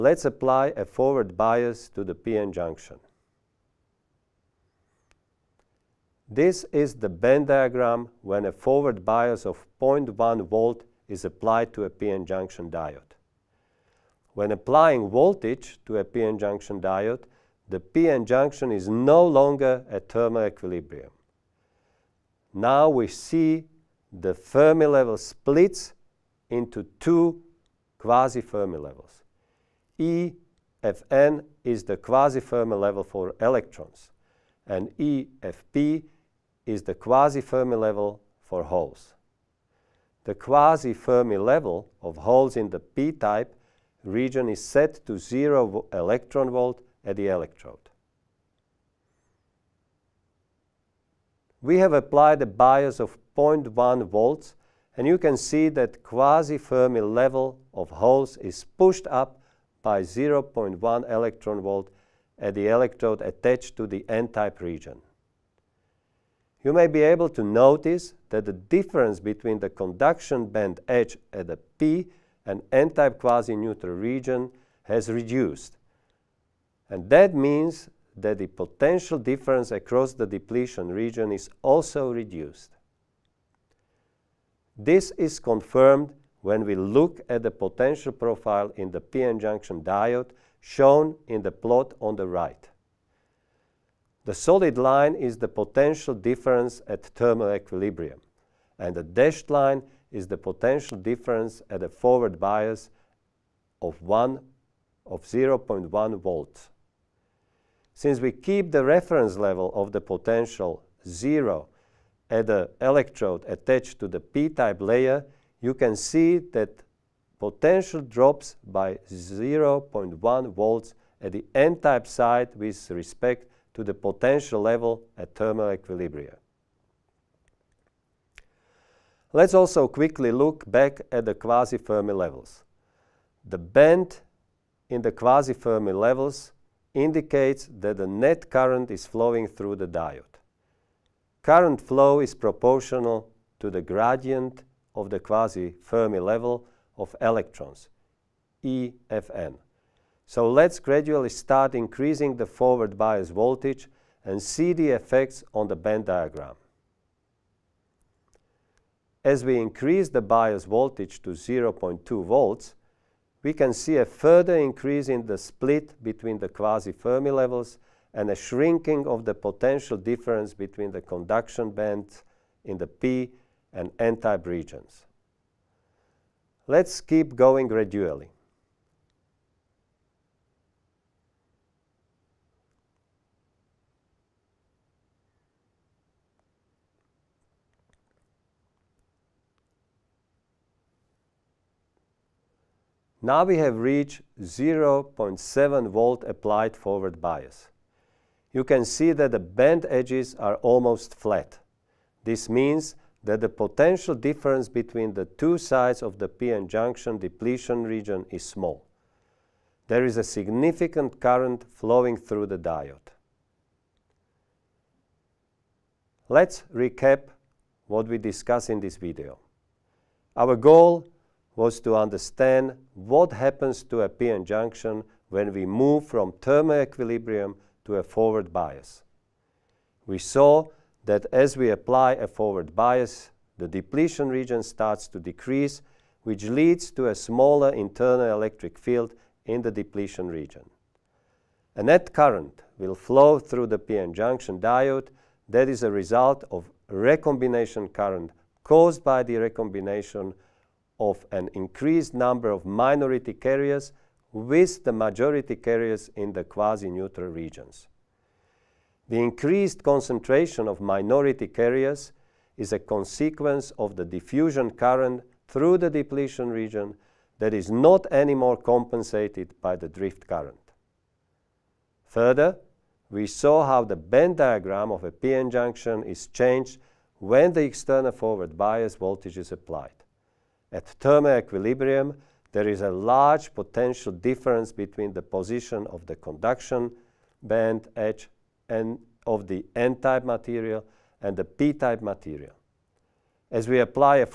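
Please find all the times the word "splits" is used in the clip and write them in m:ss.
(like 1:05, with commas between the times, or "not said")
0:25, 2:45.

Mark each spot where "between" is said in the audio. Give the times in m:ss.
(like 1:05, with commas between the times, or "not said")
1:09, 2:46, 2:50, 3:24, 4:44.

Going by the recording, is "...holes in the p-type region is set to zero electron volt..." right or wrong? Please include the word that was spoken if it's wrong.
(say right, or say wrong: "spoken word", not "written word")
right.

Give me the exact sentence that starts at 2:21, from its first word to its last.
Current flow is proportional to the gradient of the quasi-Fermi level of electrons, EFN.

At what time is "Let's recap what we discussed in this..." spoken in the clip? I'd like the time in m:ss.
3:36.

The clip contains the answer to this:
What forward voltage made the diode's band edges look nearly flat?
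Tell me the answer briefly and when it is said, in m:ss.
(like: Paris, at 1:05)
0.7 volt, at 3:14.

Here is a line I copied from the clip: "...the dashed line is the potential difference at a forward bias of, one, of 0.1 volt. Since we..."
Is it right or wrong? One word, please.
right.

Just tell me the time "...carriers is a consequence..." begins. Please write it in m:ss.
4:21.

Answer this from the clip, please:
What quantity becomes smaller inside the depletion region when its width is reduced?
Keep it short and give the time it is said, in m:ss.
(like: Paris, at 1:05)
internal electric field, at 3:57.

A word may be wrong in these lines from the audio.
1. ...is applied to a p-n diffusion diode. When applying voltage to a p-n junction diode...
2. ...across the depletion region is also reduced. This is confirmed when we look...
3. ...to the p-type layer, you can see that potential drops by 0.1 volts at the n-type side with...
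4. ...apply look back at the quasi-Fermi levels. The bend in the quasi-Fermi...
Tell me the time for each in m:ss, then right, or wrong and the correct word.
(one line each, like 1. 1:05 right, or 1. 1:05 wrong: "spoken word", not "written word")
1. 0:11 wrong: "junction", not "diffusion"
2. 1:19 right
3. 1:53 right
4. 2:09 wrong: "quickly", not "apply".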